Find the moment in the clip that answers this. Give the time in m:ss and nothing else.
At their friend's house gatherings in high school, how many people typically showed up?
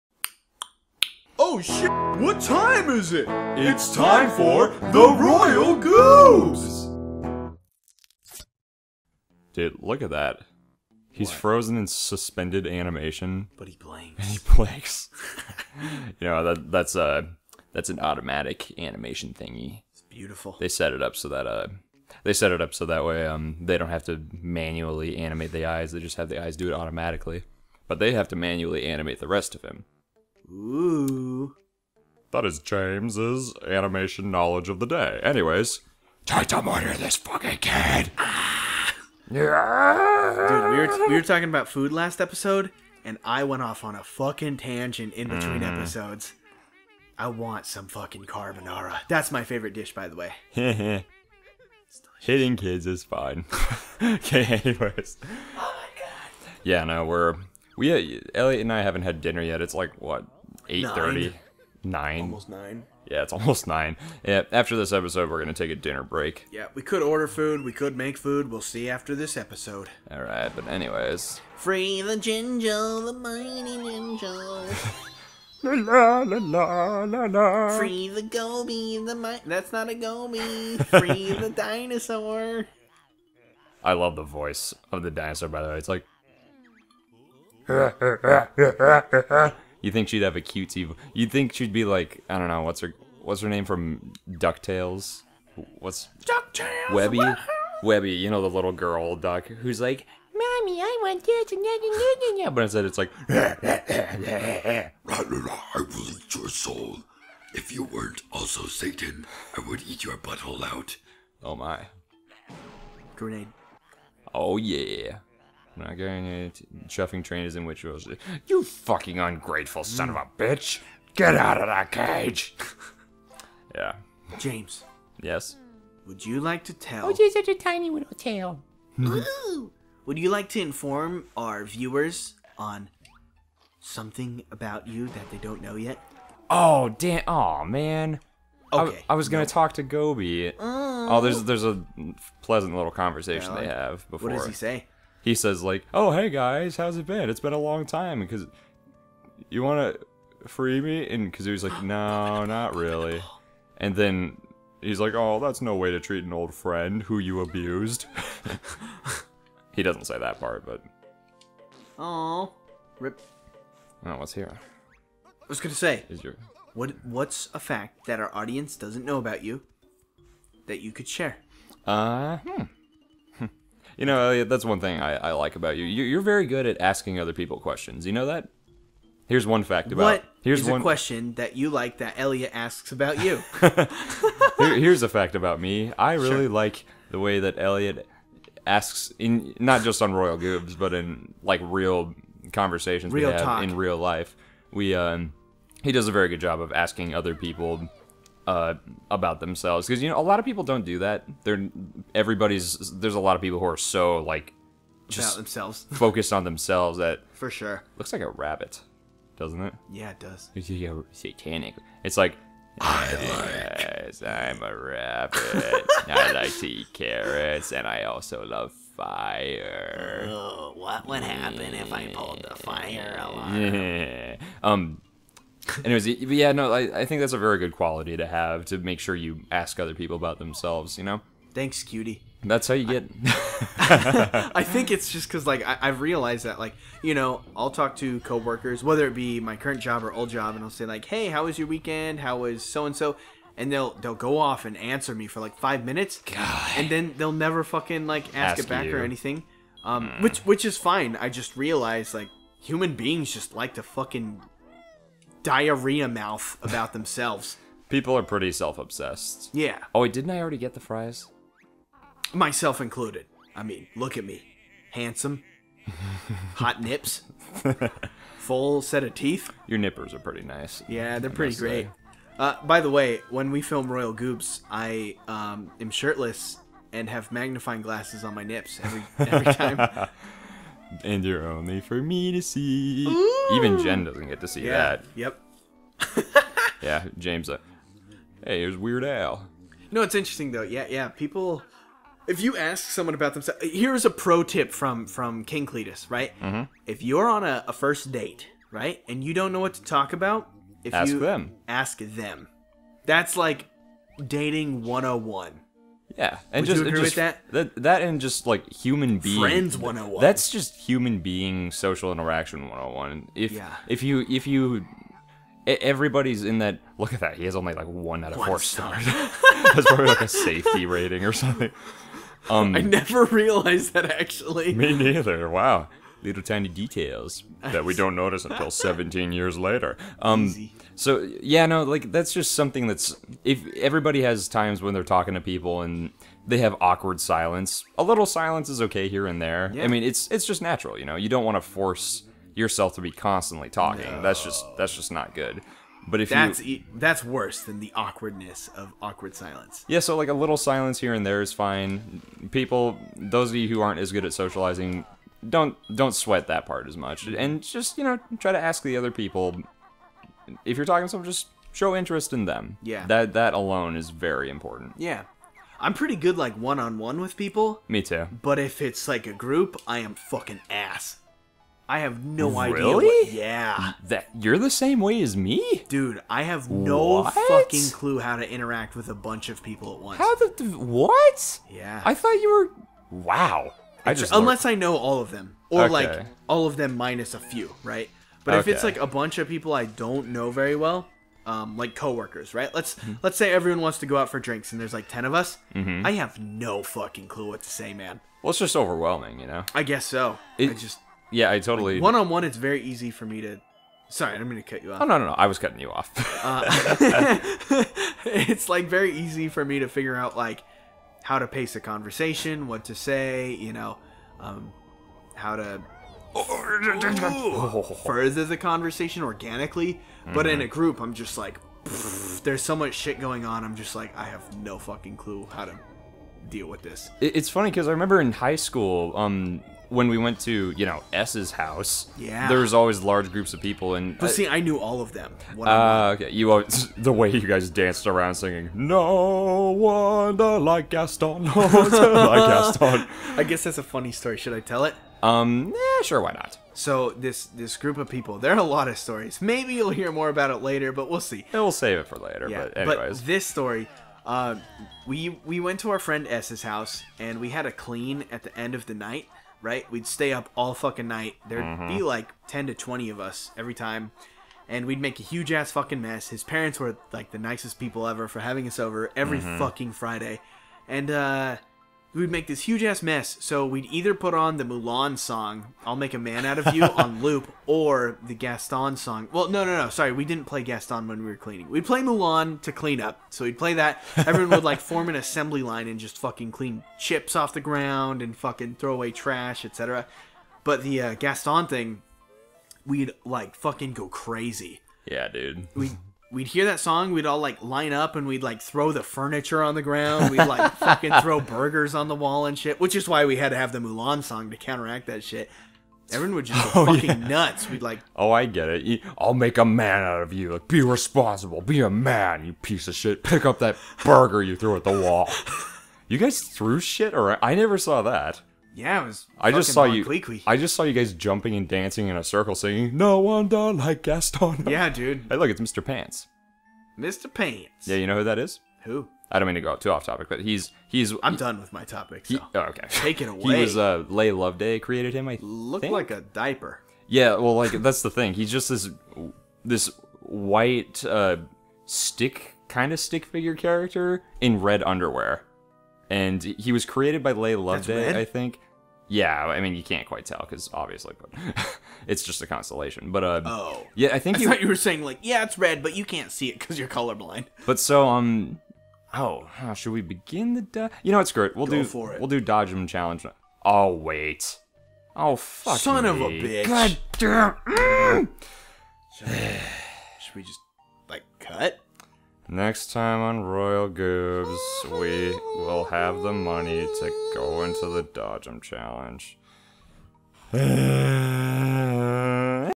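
7:42.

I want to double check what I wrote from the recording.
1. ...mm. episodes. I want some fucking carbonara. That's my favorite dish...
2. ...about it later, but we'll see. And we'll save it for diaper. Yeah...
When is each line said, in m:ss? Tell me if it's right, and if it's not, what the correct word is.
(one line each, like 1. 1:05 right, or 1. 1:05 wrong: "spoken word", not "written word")
1. 0:45 right
2. 7:30 wrong: "later", not "diaper".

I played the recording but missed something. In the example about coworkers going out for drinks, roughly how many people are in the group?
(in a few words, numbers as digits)
Ten.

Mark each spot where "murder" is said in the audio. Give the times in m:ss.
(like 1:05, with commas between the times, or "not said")
0:36.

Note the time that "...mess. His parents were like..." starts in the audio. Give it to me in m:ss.
7:46.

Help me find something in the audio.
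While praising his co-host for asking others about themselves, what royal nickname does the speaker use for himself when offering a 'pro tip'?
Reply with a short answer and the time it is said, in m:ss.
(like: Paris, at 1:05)
King Cletus, at 4:55.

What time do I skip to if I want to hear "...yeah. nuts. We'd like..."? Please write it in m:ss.
8:27.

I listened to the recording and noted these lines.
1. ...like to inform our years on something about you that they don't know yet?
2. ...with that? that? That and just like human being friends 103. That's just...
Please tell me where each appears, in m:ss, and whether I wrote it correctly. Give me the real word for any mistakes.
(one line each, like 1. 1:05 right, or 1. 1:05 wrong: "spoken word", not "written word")
1. 2:10 wrong: "viewers", not "years"
2. 5:07 wrong: "101", not "103".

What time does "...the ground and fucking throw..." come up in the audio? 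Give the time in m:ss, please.
8:07.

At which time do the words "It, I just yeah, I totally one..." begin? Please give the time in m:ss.
6:40.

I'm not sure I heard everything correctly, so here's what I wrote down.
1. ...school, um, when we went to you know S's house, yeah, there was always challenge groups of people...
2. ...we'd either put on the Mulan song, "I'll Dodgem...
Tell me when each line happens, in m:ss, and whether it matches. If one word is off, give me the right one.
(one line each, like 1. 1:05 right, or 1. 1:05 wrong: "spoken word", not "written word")
1. 7:08 wrong: "large", not "challenge"
2. 7:53 wrong: "Make", not "Dodgem".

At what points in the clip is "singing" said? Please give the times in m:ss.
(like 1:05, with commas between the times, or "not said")
7:18, 8:42.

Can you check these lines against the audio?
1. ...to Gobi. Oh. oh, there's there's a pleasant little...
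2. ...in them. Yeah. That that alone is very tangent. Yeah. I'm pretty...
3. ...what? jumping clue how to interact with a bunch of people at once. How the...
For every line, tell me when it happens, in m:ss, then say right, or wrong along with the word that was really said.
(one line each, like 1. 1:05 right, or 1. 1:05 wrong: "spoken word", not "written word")
1. 2:19 right
2. 6:02 wrong: "important", not "tangent"
3. 6:17 wrong: "fucking", not "jumping".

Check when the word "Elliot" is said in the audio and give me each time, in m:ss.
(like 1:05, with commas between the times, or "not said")
0:58, 3:02, 3:07.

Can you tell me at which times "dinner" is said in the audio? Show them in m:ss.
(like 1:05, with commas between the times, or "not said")
0:59, 1:05.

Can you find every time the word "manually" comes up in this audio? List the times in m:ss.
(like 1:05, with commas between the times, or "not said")
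0:24, 0:28.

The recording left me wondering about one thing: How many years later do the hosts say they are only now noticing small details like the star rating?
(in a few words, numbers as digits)
17.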